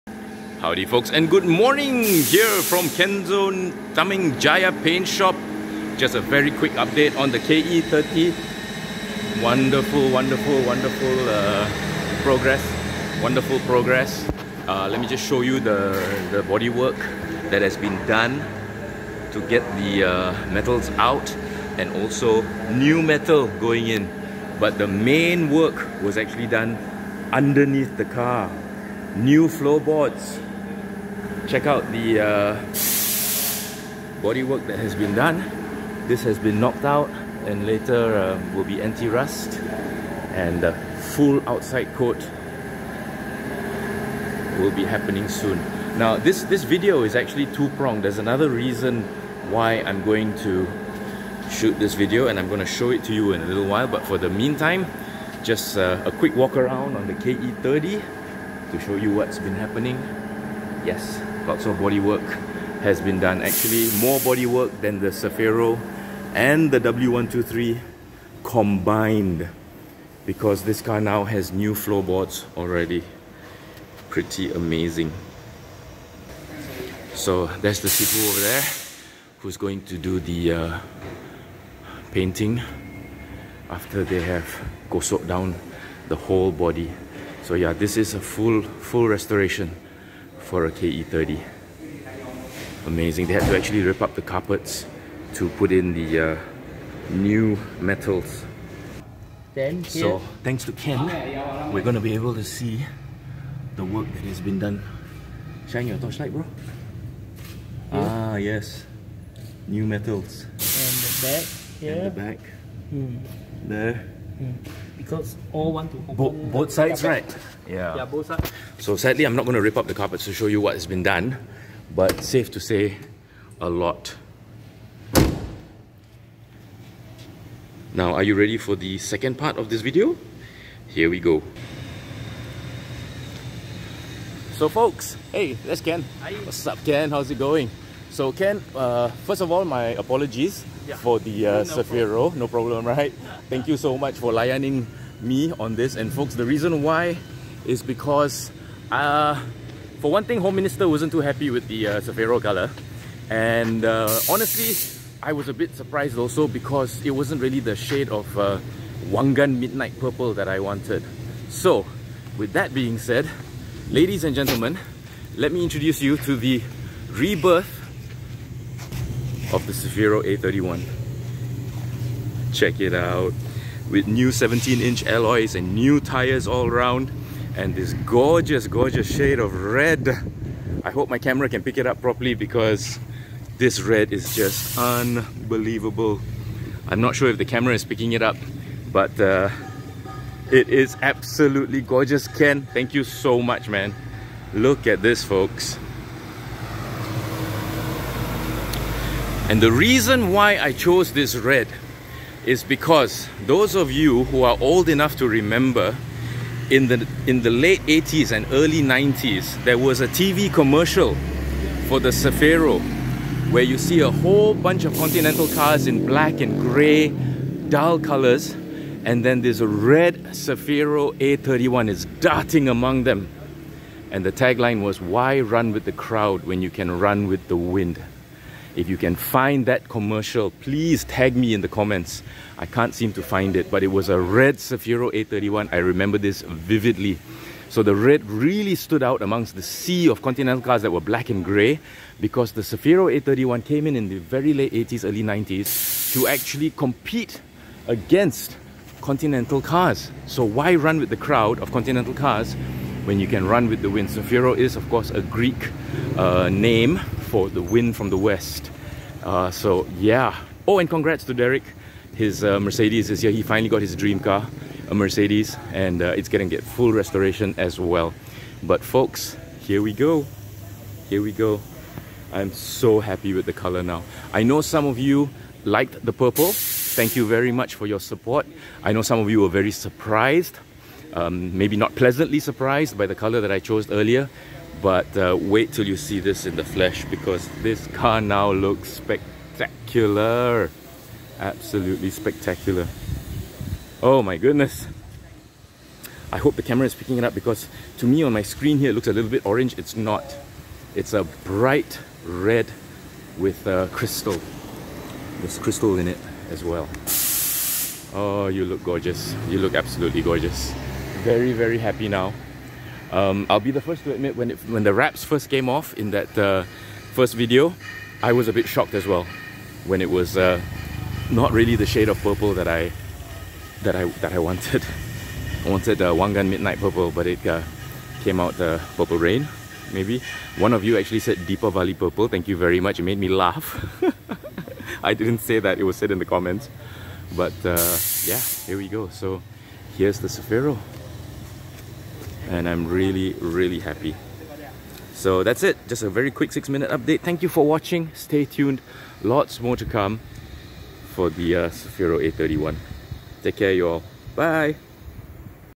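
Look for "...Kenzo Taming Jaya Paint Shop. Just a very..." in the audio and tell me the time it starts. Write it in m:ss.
0:02.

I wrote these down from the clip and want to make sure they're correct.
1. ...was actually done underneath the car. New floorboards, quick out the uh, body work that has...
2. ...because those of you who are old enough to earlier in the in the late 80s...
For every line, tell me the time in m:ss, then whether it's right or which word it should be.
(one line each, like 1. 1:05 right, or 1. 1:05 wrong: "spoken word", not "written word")
1. 0:26 wrong: "check", not "quick"
2. 3:22 wrong: "remember", not "earlier".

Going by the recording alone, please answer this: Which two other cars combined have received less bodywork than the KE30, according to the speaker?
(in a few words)
Cefiro and W123.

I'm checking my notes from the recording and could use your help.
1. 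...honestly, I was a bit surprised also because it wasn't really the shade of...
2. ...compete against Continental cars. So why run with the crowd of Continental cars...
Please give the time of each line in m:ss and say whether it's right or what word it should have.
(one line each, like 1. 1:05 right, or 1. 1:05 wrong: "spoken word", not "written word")
1. 2:34 right
2. 4:06 right.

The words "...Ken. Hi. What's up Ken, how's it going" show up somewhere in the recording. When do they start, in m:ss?
2:15.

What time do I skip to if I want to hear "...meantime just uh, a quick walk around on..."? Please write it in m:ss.
0:54.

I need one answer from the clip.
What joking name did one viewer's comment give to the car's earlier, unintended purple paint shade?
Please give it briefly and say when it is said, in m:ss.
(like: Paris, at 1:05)
Deepavali Purple, at 5:31.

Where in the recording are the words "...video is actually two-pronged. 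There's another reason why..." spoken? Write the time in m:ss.
0:46.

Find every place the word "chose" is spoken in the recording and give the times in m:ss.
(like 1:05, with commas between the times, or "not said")
3:20, 4:43.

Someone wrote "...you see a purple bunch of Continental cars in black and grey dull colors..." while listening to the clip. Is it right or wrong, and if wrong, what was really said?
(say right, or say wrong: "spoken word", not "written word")
wrong: "whole", not "purple".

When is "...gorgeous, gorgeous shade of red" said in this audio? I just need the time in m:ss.
2:58.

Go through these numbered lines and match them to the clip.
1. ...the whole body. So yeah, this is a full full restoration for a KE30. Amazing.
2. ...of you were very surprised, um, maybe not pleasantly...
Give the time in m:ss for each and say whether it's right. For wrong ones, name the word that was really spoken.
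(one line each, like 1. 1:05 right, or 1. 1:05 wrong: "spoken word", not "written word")
1. 1:26 right
2. 4:39 right.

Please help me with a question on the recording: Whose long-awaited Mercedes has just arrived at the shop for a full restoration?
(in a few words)
Derek.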